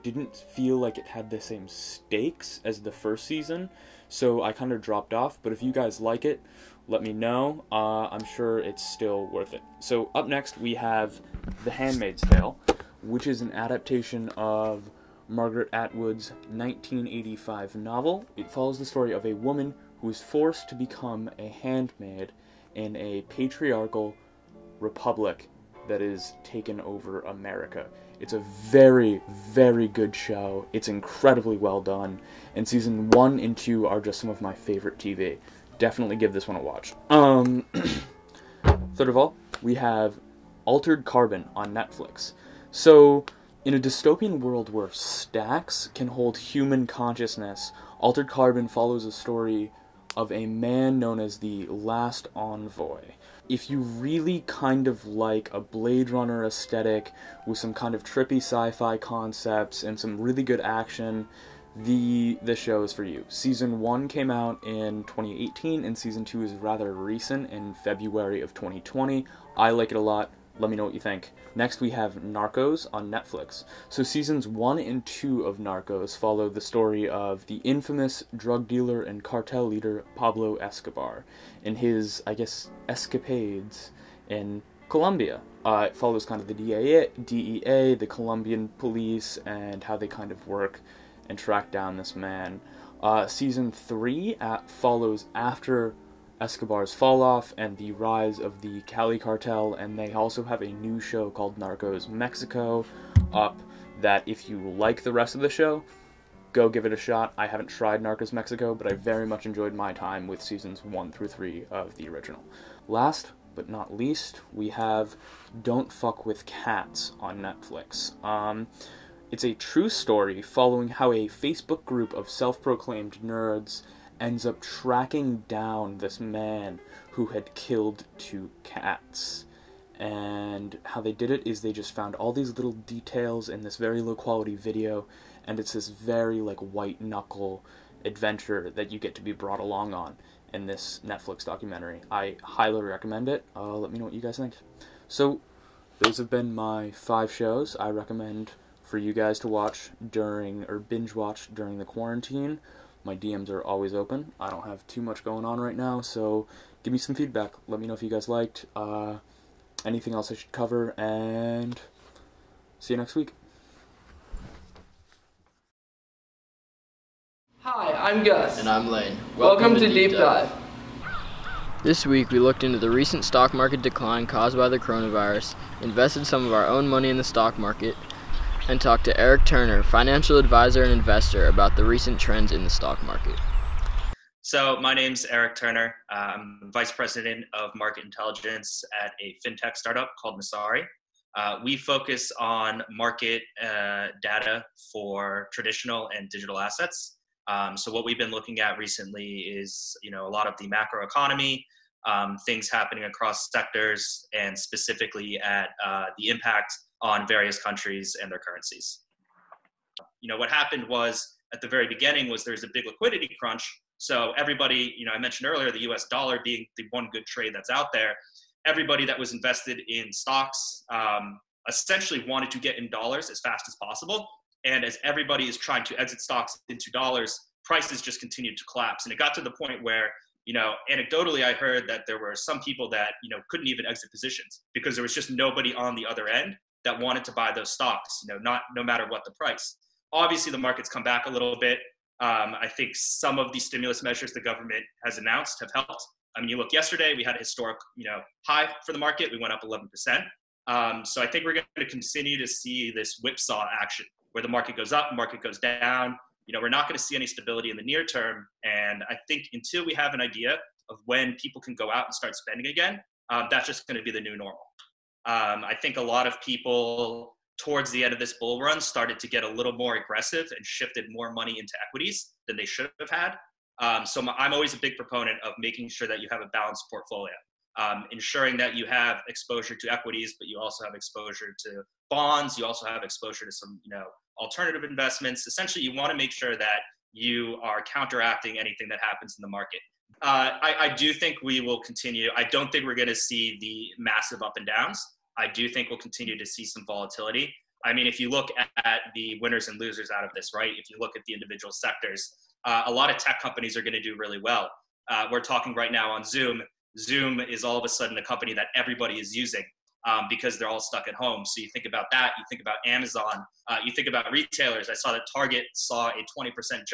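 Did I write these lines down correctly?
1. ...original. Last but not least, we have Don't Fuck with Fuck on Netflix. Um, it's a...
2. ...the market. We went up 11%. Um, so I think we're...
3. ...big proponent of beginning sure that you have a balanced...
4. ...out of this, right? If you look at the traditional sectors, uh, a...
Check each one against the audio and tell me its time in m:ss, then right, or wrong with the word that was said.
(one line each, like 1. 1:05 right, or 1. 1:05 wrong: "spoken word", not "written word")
1. 1:52 wrong: "Cats", not "Fuck"
2. 4:08 right
3. 4:34 wrong: "making", not "beginning"
4. 5:00 wrong: "individual", not "traditional".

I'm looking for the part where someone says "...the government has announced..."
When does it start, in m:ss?
4:04.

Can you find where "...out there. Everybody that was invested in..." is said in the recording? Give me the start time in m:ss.
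3:37.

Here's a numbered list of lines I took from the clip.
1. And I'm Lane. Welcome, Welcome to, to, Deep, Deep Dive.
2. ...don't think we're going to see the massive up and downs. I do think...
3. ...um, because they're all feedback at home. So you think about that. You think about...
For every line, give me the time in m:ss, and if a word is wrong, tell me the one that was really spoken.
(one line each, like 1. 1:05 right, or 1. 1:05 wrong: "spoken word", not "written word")
1. 2:48 right
2. 4:52 right
3. 5:10 wrong: "stuck", not "feedback".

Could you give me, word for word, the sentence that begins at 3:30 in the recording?
You know, what happened was at the very beginning was there's a big liquidity crunch.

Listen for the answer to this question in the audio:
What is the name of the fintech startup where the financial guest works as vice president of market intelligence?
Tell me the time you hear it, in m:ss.
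3:10.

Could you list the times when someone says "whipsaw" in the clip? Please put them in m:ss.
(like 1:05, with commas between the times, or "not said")
4:13.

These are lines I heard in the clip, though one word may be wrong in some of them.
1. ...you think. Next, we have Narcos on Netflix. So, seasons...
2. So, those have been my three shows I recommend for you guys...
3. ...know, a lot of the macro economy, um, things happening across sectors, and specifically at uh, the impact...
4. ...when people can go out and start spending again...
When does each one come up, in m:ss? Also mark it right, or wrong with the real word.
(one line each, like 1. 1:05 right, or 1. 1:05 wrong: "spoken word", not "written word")
1. 1:10 right
2. 2:25 wrong: "five", not "three"
3. 3:20 right
4. 4:21 right.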